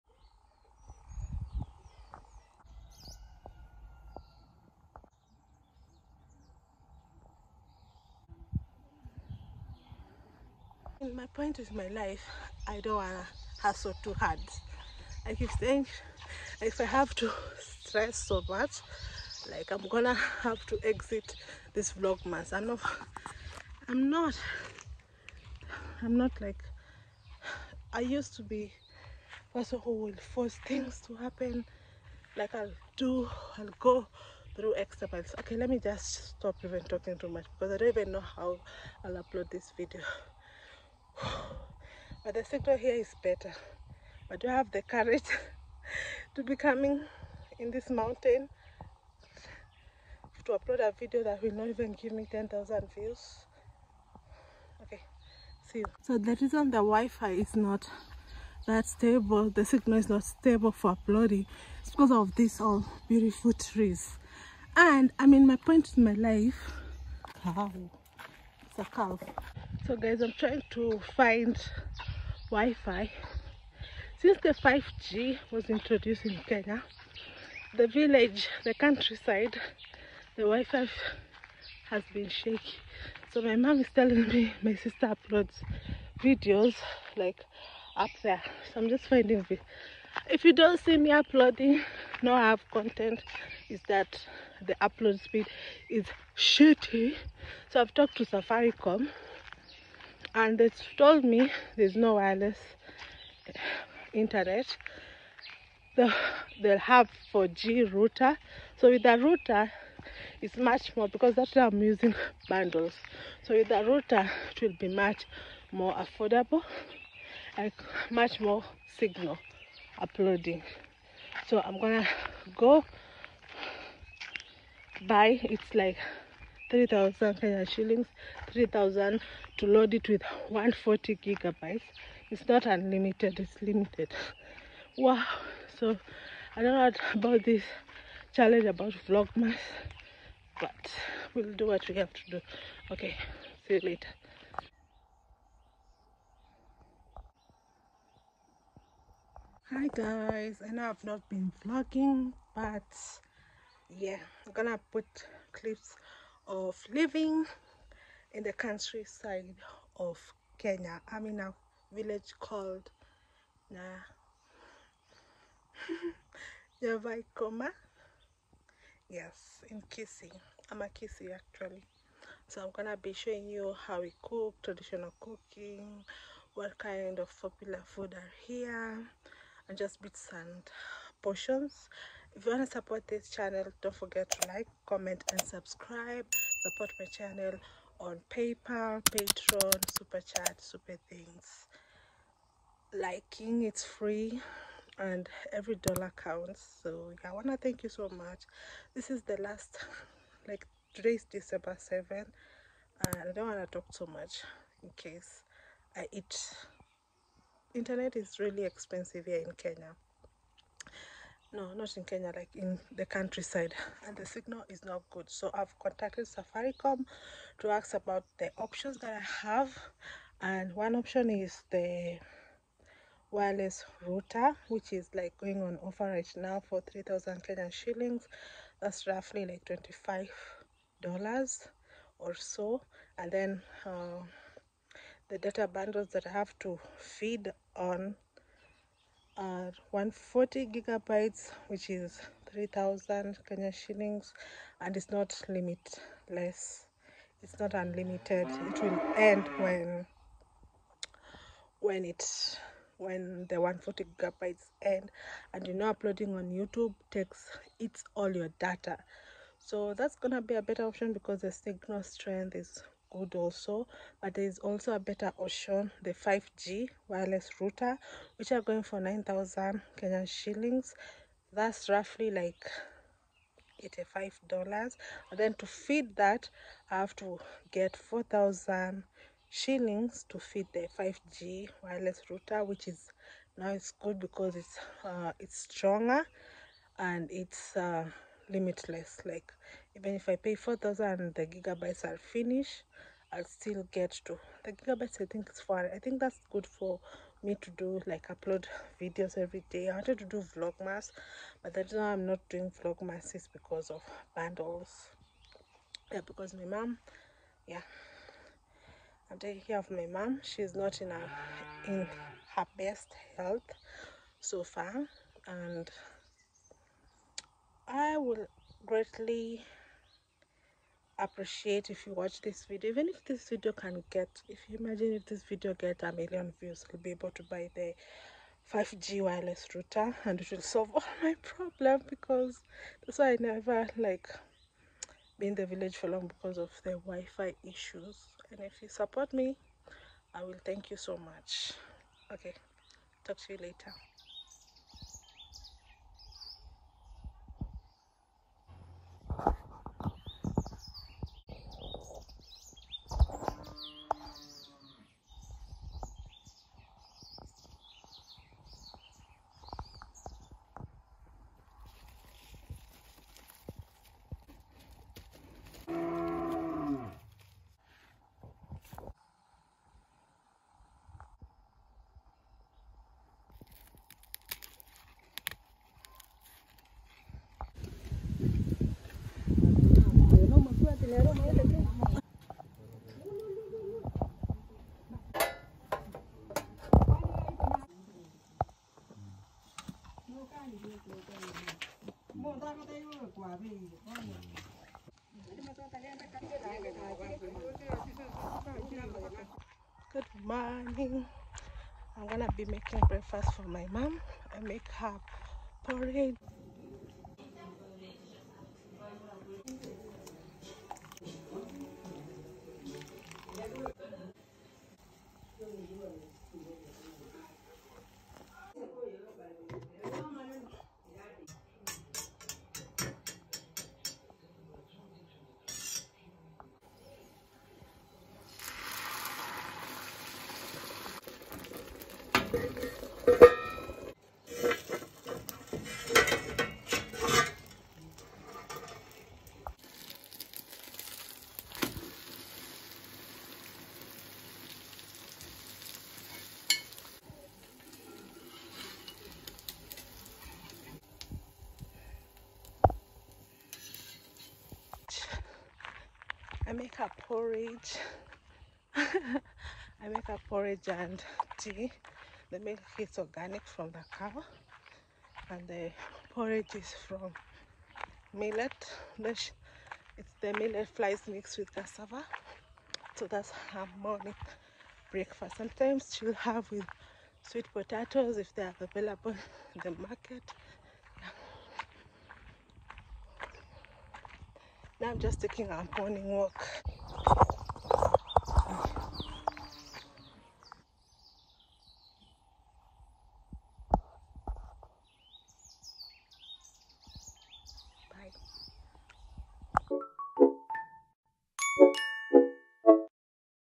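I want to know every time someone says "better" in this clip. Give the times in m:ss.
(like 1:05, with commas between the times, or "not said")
0:43, 4:20, 4:24.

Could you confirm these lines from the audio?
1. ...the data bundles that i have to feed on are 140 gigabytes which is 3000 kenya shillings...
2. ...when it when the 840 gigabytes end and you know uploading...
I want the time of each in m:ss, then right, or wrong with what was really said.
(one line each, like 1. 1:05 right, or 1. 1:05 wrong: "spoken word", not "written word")
1. 3:55 right
2. 4:11 wrong: "140", not "840".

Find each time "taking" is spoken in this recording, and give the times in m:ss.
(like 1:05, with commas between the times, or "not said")
5:09, 8:05.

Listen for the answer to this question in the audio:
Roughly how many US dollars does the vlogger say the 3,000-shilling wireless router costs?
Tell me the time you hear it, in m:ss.
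3:49.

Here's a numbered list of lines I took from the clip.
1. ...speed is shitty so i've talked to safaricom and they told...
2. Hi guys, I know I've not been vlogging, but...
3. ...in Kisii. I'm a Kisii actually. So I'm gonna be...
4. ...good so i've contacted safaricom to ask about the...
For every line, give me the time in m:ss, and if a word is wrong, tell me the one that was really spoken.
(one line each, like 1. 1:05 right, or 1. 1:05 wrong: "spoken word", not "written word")
1. 1:35 right
2. 2:29 right
3. 2:49 right
4. 3:35 right.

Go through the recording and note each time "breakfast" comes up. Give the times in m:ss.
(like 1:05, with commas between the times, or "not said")
6:43, 7:55.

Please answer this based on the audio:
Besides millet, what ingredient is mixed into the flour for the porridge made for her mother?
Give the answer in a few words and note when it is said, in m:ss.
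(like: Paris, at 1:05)
cassava, at 7:51.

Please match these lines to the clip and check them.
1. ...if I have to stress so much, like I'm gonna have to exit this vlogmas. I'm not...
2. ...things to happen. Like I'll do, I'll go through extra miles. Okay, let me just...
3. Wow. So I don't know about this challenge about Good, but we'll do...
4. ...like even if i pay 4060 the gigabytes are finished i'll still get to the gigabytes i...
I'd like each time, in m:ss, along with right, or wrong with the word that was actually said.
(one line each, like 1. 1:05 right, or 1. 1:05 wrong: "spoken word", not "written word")
1. 0:16 right
2. 0:30 right
3. 2:14 wrong: "Vlogmas", not "Good"
4. 4:49 wrong: "4000", not "4060".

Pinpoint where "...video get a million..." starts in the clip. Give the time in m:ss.
5:25.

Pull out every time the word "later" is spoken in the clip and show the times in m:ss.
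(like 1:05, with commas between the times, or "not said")
2:23, 5:43.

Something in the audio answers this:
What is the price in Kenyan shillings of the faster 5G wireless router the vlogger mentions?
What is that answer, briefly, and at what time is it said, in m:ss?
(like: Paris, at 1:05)
9000 shillings, at 4:28.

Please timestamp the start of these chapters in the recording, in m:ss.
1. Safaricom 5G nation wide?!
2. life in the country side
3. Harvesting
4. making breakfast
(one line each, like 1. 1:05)
1. 1:37
2. 1:12
3. 6:03
4. 6:22.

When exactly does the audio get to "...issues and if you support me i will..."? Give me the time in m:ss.
5:37.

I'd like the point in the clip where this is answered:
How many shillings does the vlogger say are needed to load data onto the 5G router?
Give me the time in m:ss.
4:37.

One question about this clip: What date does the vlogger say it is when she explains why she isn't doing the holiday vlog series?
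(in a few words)
December 7.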